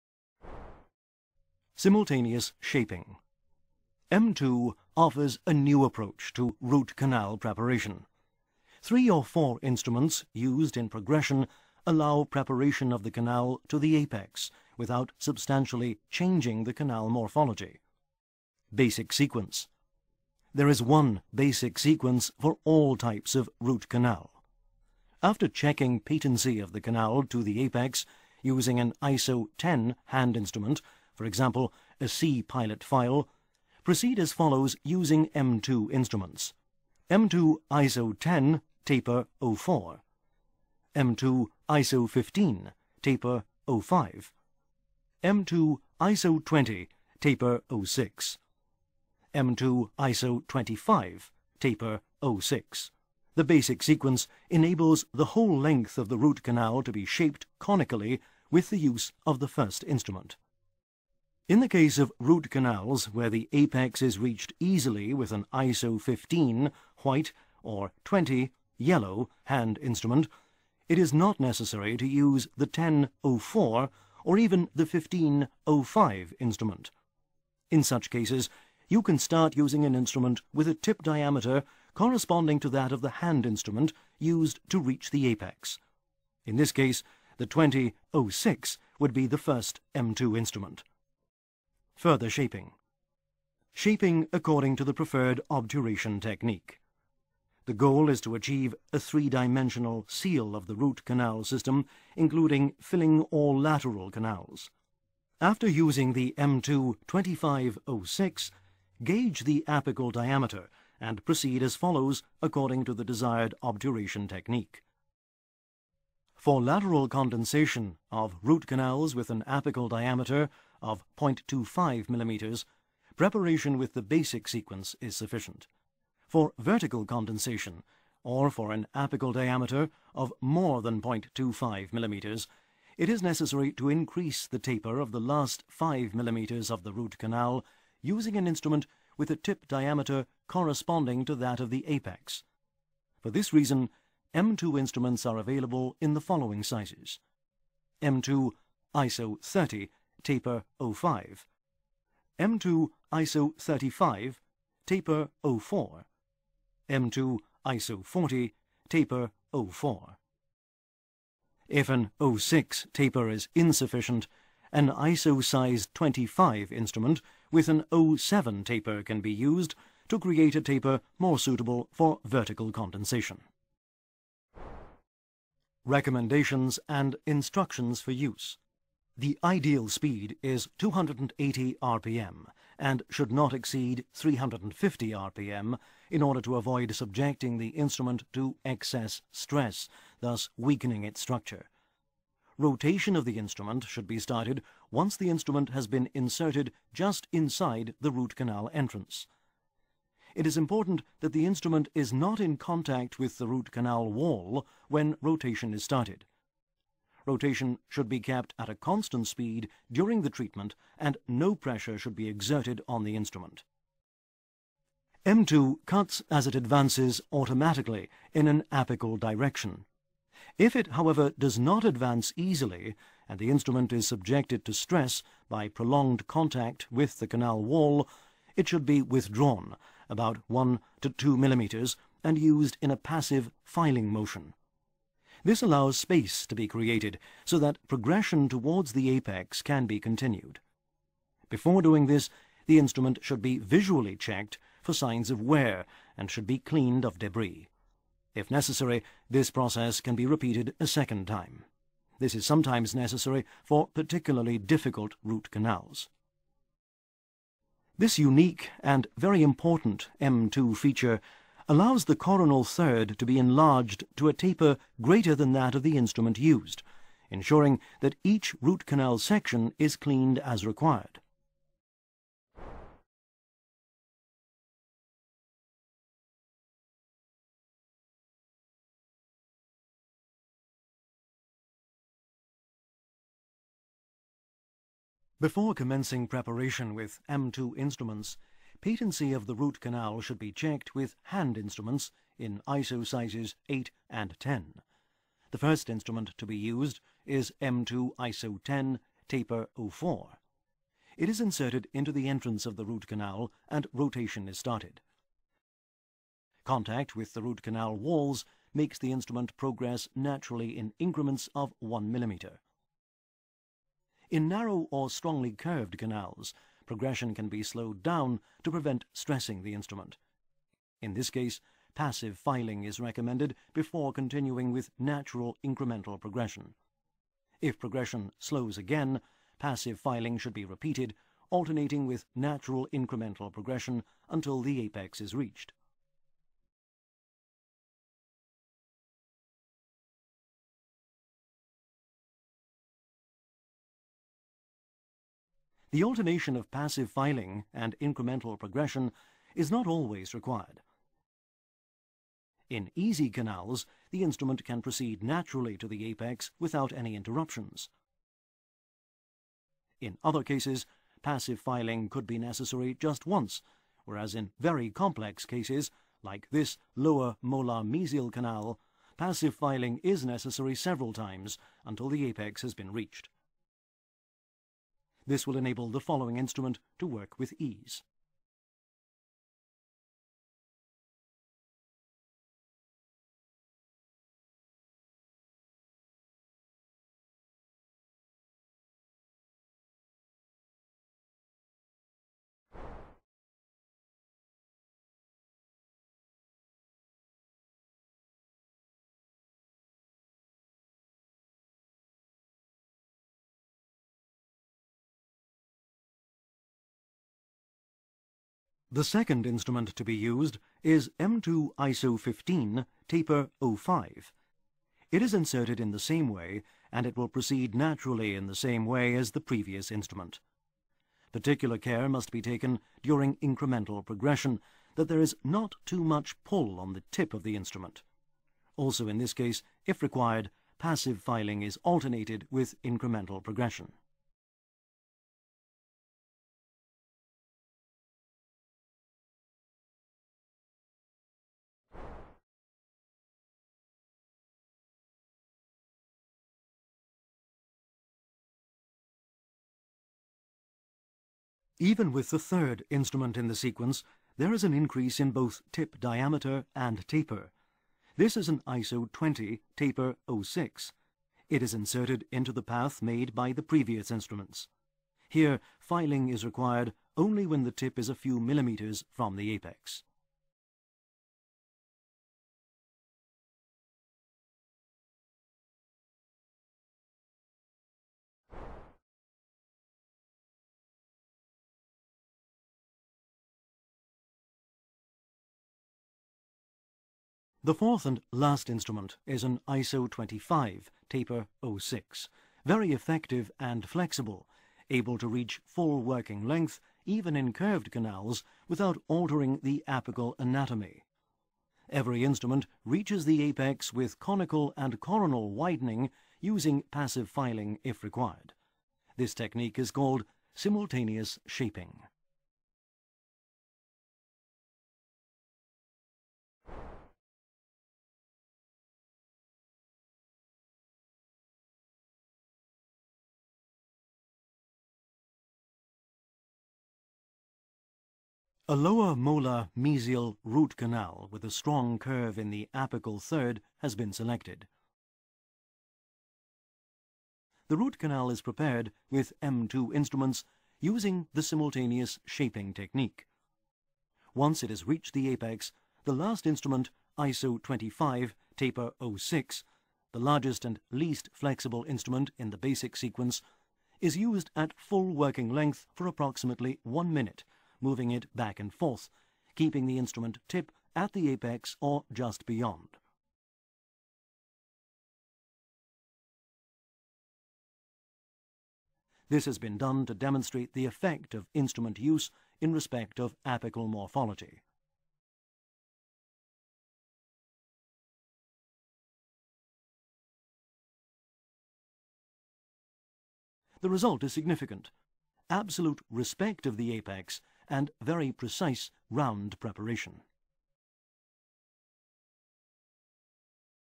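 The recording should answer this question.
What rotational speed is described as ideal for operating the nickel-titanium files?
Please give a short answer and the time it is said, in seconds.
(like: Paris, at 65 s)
280 RPM, at 180 s.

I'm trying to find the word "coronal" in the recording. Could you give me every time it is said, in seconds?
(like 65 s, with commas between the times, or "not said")
262 s, 504 s.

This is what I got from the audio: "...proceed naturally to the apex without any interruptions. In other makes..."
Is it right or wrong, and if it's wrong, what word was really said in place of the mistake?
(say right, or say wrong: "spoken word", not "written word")
wrong: "cases", not "makes".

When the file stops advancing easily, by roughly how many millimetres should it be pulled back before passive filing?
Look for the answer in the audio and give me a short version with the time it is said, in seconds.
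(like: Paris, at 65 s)
1 to 2 millimeters, at 230 s.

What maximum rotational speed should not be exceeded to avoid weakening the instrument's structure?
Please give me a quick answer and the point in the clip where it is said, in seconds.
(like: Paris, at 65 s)
350 RPM, at 184 s.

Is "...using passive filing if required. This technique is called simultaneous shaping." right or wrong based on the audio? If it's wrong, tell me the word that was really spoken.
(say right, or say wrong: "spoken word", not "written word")
right.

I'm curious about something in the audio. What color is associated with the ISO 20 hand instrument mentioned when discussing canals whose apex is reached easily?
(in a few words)
yellow.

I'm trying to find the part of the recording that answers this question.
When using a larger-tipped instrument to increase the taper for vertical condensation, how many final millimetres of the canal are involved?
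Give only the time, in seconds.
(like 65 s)
135 s.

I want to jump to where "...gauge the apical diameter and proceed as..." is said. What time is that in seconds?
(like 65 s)
109 s.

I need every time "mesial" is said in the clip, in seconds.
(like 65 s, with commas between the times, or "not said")
367 s, 529 s.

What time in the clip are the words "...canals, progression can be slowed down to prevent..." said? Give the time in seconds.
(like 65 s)
315 s.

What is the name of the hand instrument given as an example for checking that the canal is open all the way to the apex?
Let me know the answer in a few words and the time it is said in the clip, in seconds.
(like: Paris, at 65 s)
C pilot file, at 32 s.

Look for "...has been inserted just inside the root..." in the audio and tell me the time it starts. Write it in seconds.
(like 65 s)
195 s.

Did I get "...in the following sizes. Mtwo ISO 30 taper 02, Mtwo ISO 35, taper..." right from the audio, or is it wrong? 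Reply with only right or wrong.
wrong.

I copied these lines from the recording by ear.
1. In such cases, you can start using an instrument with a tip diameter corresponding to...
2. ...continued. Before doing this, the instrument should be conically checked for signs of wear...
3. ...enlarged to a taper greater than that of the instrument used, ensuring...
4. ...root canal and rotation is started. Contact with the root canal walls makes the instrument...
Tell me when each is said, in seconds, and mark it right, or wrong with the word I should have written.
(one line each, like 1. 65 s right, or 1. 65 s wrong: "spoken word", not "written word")
1. 77 s right
2. 239 s wrong: "visually", not "conically"
3. 263 s right
4. 302 s right.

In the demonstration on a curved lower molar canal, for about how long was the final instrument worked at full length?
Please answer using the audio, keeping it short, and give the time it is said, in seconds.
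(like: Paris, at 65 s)
one minute, at 556 s.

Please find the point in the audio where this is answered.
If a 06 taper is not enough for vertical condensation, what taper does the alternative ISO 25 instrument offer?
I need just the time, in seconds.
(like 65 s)
168 s.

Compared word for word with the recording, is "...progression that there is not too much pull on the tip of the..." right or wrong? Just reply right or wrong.
right.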